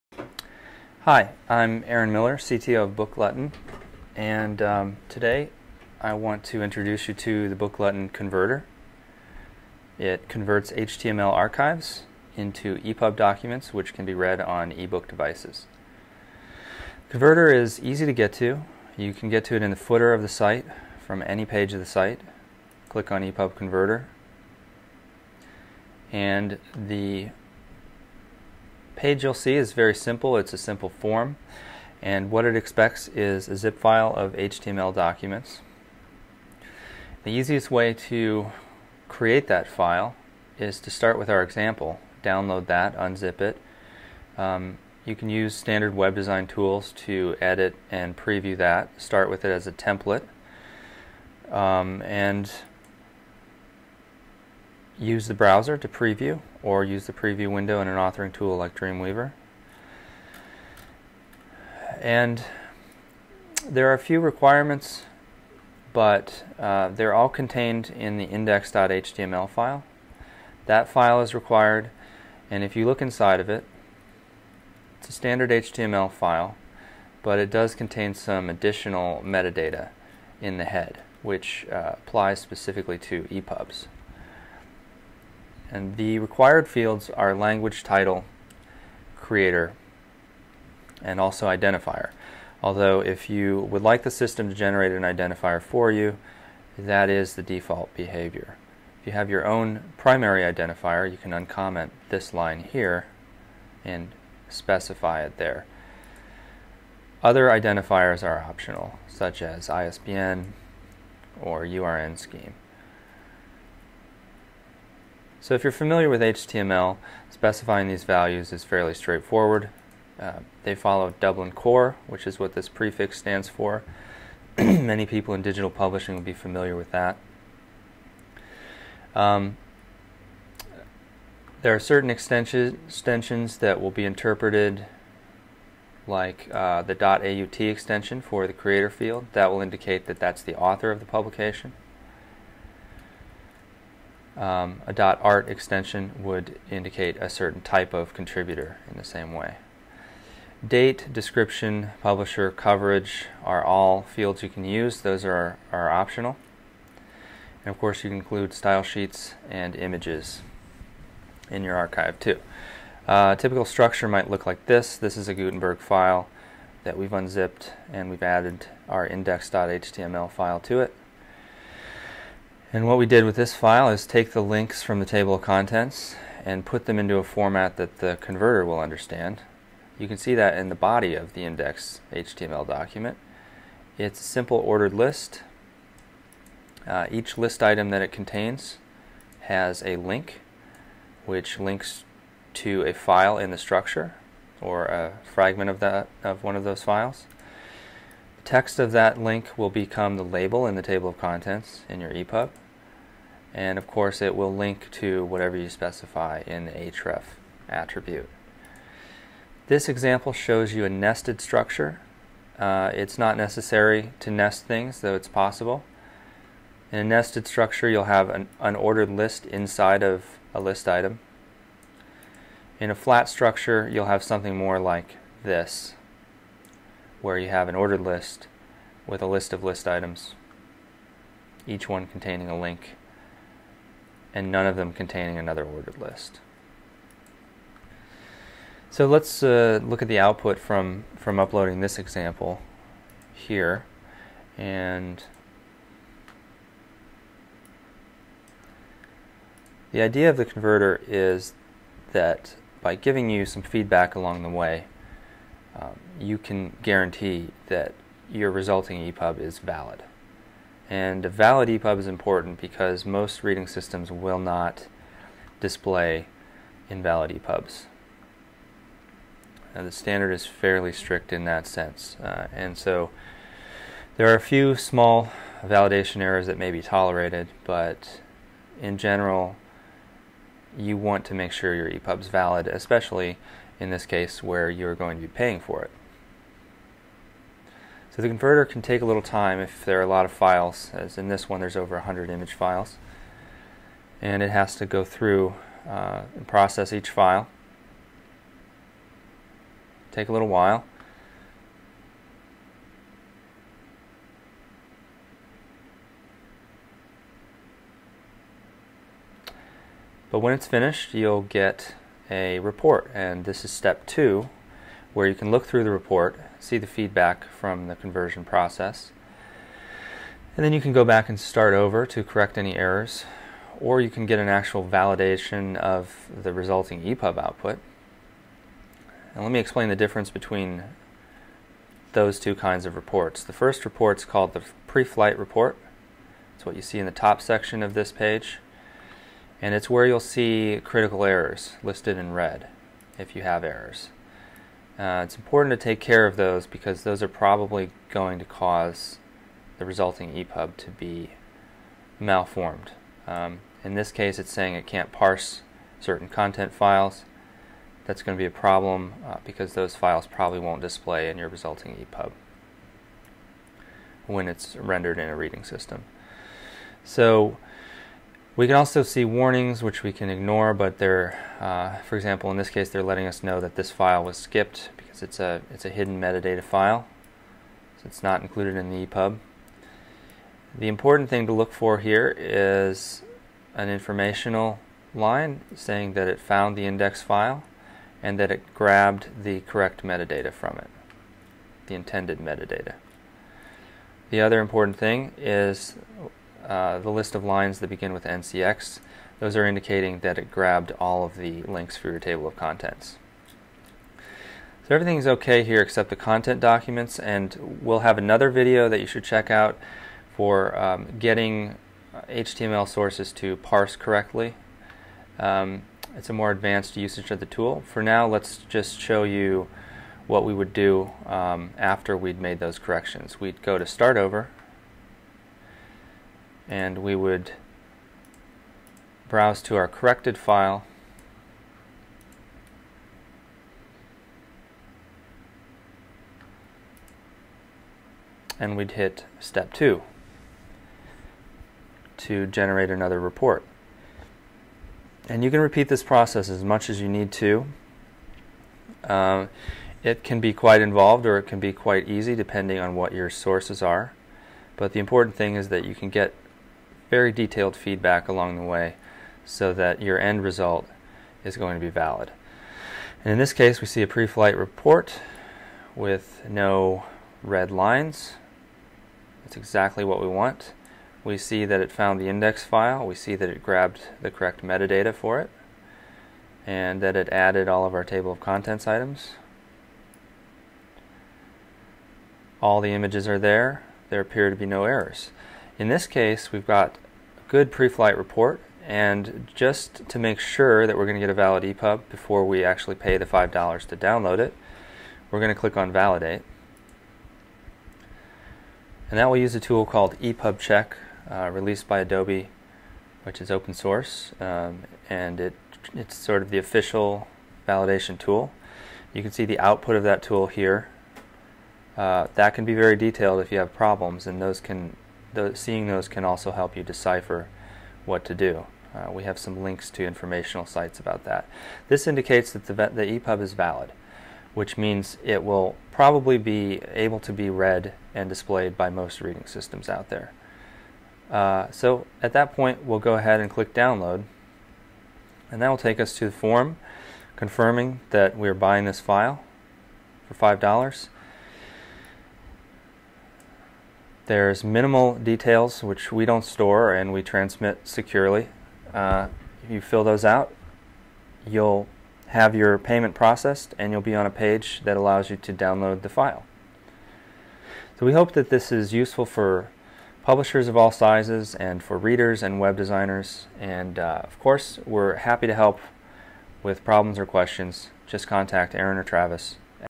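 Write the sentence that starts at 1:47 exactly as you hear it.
Other identifiers are optional, such as ISBN or URN scheme.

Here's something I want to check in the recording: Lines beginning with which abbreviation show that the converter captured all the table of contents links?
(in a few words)
NCX.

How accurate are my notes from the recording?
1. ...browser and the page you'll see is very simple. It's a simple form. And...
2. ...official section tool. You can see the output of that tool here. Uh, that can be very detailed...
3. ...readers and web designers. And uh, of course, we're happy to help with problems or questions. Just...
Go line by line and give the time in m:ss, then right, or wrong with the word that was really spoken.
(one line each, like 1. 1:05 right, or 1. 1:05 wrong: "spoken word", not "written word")
1. 0:23 wrong: "converter", not "browser"
2. 8:26 wrong: "validation", not "section"
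3. 9:21 right.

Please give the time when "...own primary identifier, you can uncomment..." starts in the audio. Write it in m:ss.
1:39.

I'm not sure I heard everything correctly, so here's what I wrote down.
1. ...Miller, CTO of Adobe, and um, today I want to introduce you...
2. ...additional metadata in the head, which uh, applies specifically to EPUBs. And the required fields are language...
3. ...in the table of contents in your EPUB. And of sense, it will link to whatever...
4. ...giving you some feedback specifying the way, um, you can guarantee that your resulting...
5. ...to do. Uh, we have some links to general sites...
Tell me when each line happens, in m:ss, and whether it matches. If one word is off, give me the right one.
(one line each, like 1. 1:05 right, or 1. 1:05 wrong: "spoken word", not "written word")
1. 0:02 wrong: "BookGlutton", not "Adobe"
2. 1:18 right
3. 3:20 wrong: "course", not "sense"
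4. 4:12 wrong: "along", not "specifying"
5. 8:38 wrong: "informational", not "general".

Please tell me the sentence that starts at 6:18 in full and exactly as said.
So it's not included in the EPUB.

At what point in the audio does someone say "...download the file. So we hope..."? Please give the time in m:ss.
9:15.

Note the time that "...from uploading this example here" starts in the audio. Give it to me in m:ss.
4:01.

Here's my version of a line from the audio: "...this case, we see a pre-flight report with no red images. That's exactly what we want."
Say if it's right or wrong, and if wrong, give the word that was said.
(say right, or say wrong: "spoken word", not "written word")
wrong: "lines", not "images".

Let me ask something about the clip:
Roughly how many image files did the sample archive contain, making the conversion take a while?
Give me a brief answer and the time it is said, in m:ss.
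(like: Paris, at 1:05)
over 100, at 4:51.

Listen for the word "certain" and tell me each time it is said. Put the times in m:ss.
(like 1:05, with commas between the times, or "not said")
2:11, 2:27, 5:55.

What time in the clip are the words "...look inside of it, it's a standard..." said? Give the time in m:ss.
1:12.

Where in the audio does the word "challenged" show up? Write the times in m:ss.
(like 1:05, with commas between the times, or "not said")
not said.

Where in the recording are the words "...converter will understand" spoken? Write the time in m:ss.
2:58.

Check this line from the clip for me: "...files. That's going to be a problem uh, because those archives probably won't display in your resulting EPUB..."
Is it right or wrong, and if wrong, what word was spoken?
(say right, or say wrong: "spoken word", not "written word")
wrong: "files", not "archives".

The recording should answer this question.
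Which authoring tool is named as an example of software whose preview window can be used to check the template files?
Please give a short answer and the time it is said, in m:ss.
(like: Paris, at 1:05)
Dreamweaver, at 0:58.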